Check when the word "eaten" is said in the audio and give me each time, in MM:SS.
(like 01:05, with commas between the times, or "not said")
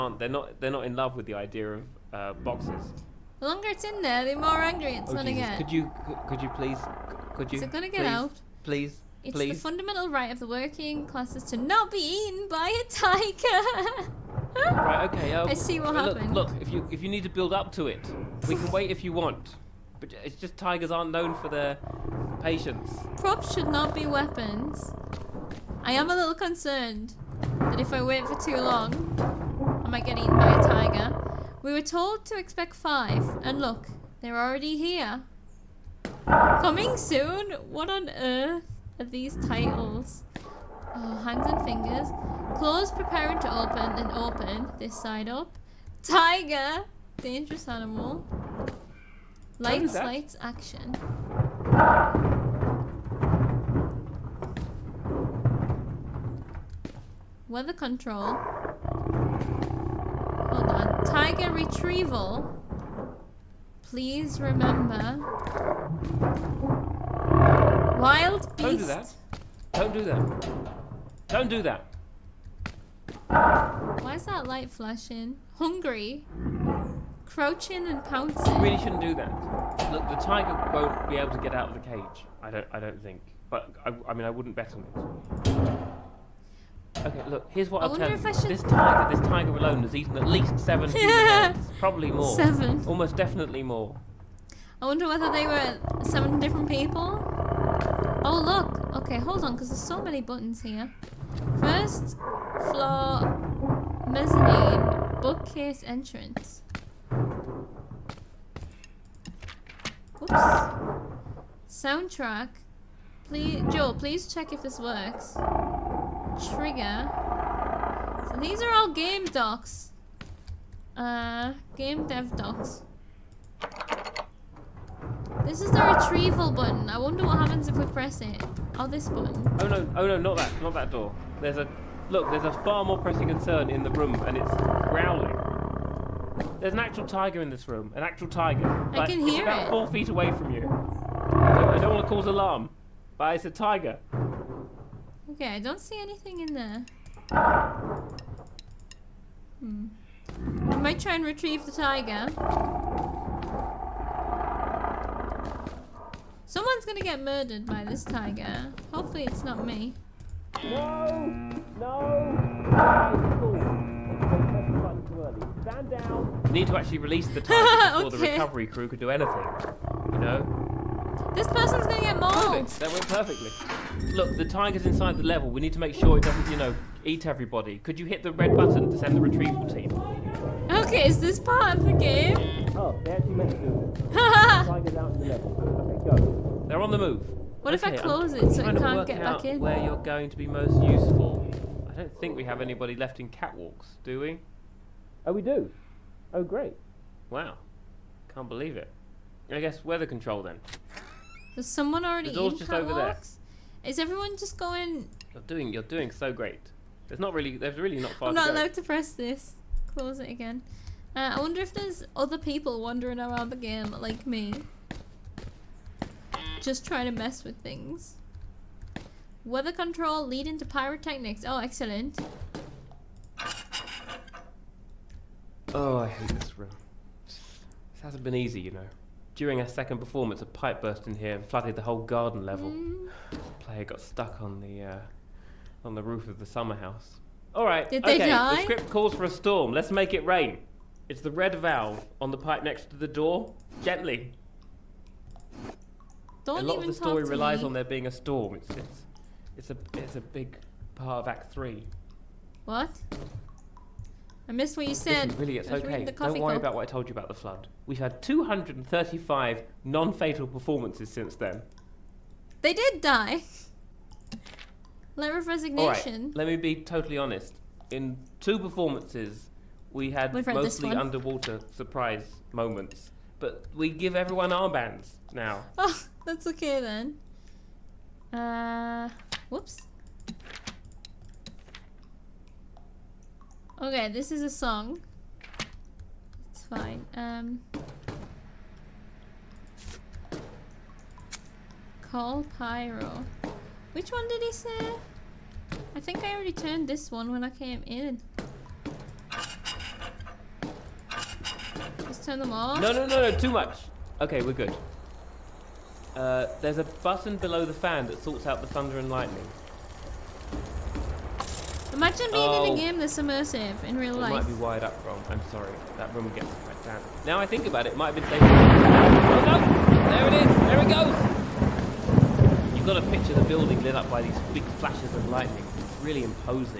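00:11, 00:30, 01:29.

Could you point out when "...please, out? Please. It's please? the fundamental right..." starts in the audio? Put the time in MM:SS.
00:08.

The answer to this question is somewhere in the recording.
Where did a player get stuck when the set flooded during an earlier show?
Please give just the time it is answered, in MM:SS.
03:56.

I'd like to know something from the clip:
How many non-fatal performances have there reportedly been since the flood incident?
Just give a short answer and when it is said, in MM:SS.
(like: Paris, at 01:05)
235, at 04:18.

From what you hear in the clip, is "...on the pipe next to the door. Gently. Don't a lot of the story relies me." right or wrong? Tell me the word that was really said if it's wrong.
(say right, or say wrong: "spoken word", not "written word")
right.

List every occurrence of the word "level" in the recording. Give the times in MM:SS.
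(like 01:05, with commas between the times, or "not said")
02:55, 03:05, 03:52.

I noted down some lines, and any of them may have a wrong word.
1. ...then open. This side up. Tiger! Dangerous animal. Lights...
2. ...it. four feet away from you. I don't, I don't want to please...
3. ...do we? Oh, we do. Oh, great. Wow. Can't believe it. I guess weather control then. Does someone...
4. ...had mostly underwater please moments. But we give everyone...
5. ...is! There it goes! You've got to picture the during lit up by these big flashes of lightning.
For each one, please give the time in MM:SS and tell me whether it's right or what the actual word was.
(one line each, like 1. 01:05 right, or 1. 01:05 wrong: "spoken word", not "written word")
1. 00:43 right
2. 02:19 wrong: "cause", not "please"
3. 03:14 right
4. 04:30 wrong: "surprise", not "please"
5. 05:20 wrong: "building", not "during".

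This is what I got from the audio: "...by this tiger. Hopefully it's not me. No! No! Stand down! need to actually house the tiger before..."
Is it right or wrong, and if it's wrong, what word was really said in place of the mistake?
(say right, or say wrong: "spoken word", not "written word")
wrong: "release", not "house".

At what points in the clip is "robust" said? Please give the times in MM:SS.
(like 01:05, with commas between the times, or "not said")
not said.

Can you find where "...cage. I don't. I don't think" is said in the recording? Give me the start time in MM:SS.
01:21.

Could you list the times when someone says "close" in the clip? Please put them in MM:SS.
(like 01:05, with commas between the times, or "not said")
03:08, 03:29.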